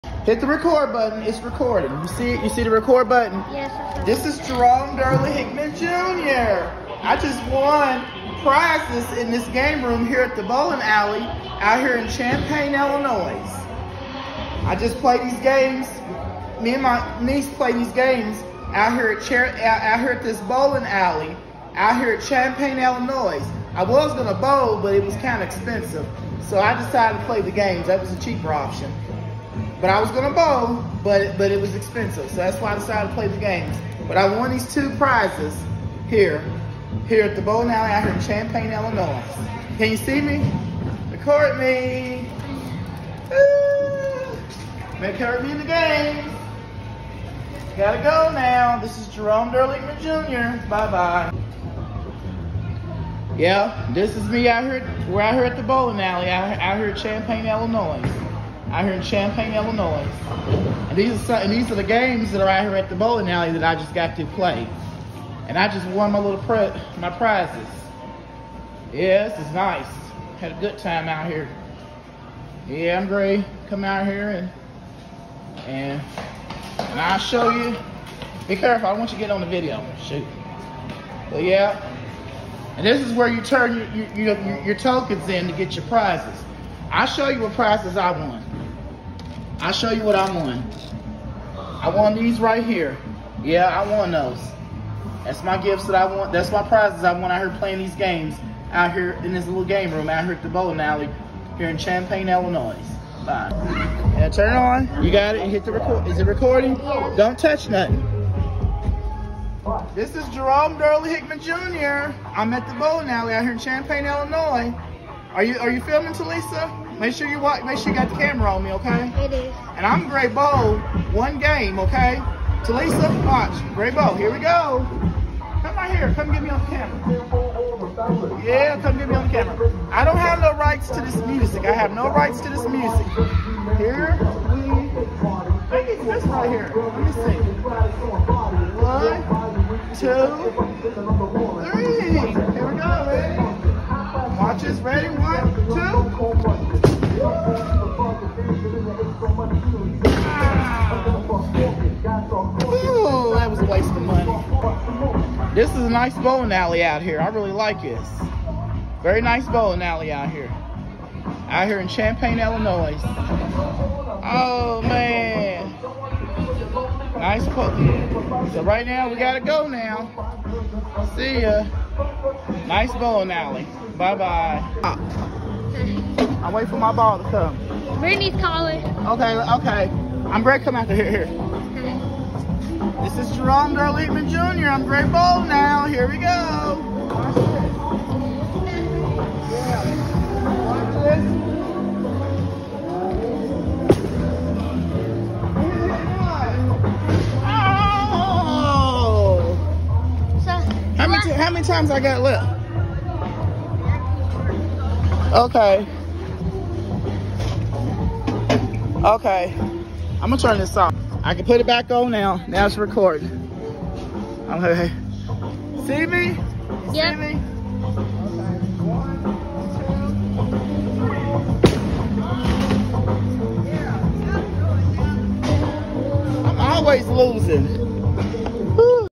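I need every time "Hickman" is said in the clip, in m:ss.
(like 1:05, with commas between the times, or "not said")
0:05, 1:51.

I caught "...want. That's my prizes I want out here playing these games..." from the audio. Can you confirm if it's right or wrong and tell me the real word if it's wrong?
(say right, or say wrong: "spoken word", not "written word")
right.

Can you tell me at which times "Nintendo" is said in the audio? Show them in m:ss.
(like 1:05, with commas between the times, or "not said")
not said.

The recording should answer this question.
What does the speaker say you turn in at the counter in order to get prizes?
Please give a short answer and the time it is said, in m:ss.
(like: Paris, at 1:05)
Tokens, at 1:24.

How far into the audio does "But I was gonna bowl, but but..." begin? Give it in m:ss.
0:29.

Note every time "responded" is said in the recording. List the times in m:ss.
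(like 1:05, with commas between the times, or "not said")
not said.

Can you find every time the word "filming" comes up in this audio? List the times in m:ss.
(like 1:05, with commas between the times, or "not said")
1:55.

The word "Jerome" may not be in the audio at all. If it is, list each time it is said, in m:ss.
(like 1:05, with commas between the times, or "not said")
0:04, 0:49, 1:50, 3:03.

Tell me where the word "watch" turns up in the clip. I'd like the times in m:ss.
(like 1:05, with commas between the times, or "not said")
1:57, 2:03, 2:24.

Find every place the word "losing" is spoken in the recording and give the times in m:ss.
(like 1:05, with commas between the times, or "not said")
3:47.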